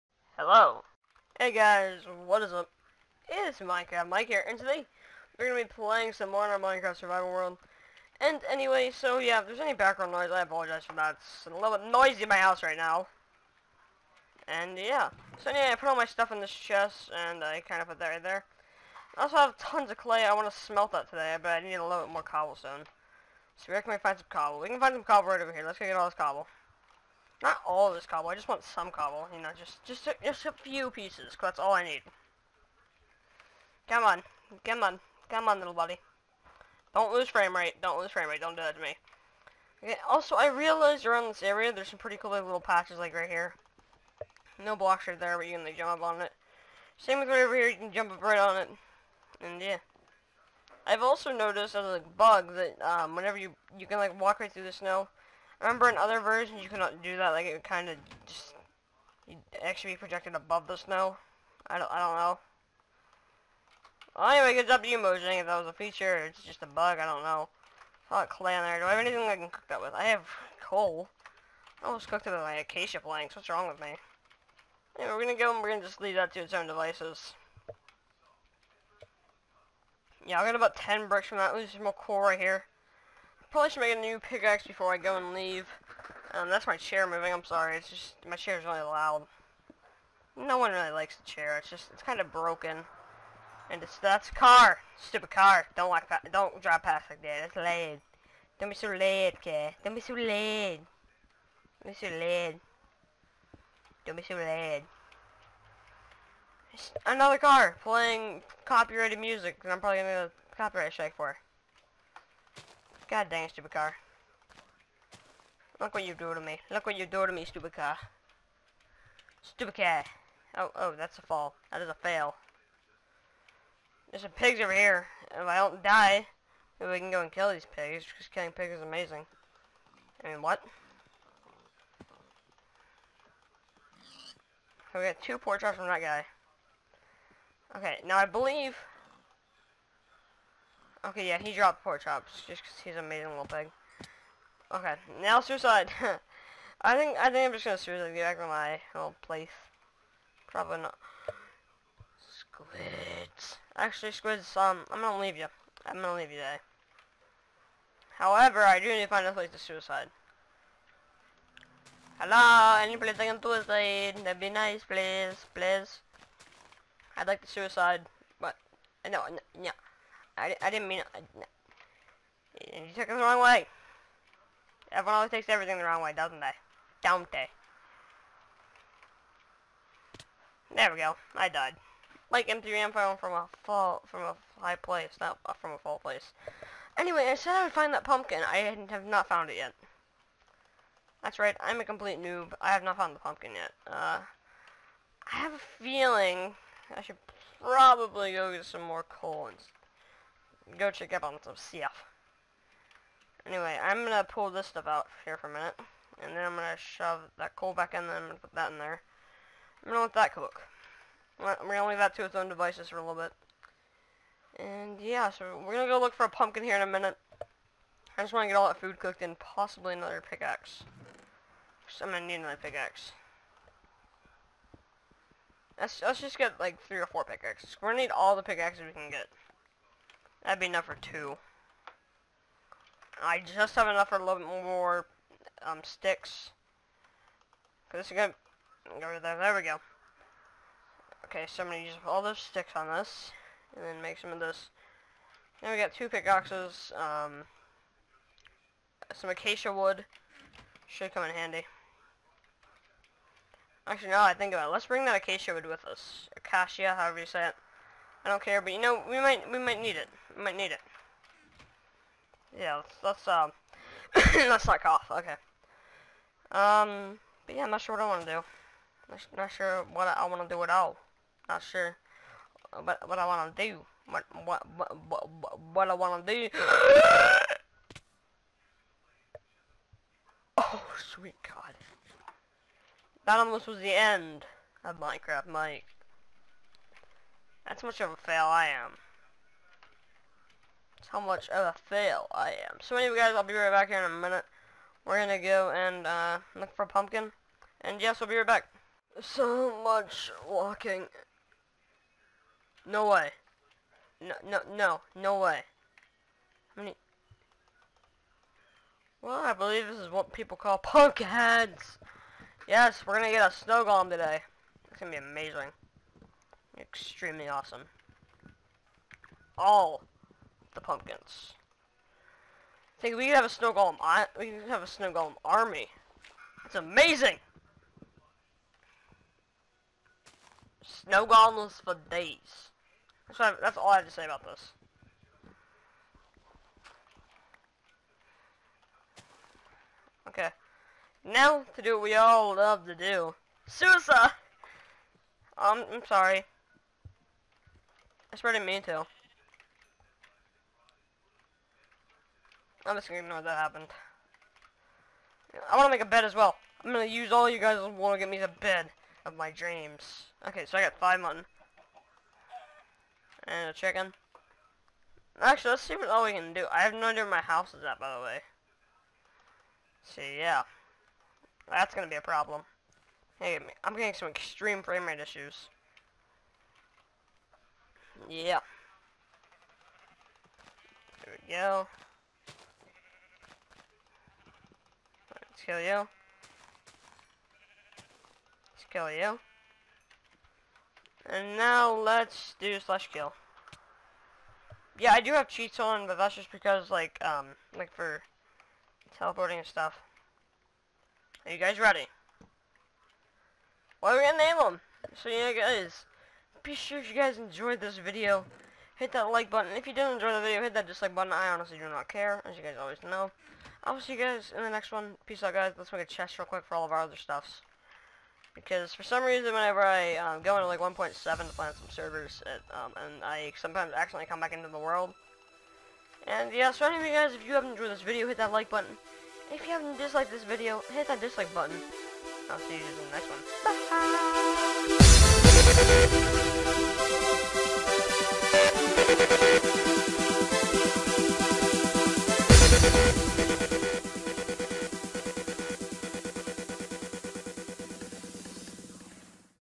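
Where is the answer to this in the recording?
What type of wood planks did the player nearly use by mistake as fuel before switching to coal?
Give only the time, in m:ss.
1:12.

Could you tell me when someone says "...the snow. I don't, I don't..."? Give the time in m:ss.
1:00.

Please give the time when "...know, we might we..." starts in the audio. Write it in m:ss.
4:18.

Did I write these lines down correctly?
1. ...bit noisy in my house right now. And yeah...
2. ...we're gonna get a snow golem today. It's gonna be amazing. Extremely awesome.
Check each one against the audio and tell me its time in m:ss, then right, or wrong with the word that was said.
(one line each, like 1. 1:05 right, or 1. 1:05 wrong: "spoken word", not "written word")
1. 0:11 right
2. 5:13 right.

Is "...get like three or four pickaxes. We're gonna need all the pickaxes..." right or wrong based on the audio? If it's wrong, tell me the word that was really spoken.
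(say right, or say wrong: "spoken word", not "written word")
right.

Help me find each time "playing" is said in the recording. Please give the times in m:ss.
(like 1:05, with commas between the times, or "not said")
0:05, 1:47.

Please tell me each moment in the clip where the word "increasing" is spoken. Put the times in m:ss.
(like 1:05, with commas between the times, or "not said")
not said.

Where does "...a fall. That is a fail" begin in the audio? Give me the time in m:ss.
2:01.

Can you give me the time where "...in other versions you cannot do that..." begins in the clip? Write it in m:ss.
0:55.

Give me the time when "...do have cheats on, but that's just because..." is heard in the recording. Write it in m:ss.
6:35.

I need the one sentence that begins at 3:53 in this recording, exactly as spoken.
I just have enough for a little more um, sticks.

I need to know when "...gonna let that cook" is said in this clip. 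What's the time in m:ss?
3:29.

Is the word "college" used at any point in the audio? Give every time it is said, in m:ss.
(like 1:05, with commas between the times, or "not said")
not said.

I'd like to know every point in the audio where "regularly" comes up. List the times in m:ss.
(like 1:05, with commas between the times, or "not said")
not said.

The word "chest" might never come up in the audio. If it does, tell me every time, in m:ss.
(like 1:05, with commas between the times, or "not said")
0:16, 6:56.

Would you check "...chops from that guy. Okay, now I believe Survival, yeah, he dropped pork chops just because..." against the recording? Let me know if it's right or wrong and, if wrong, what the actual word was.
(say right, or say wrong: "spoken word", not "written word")
wrong: "Okay", not "Survival".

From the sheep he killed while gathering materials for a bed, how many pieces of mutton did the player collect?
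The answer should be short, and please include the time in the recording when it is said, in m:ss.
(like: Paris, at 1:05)
5, at 6:00.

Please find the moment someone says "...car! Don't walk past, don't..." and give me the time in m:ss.
1:35.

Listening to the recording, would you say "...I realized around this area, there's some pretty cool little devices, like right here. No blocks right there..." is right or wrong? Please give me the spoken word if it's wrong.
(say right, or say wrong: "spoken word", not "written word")
wrong: "patches", not "devices".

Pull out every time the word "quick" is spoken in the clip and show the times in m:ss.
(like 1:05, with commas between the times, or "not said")
6:56.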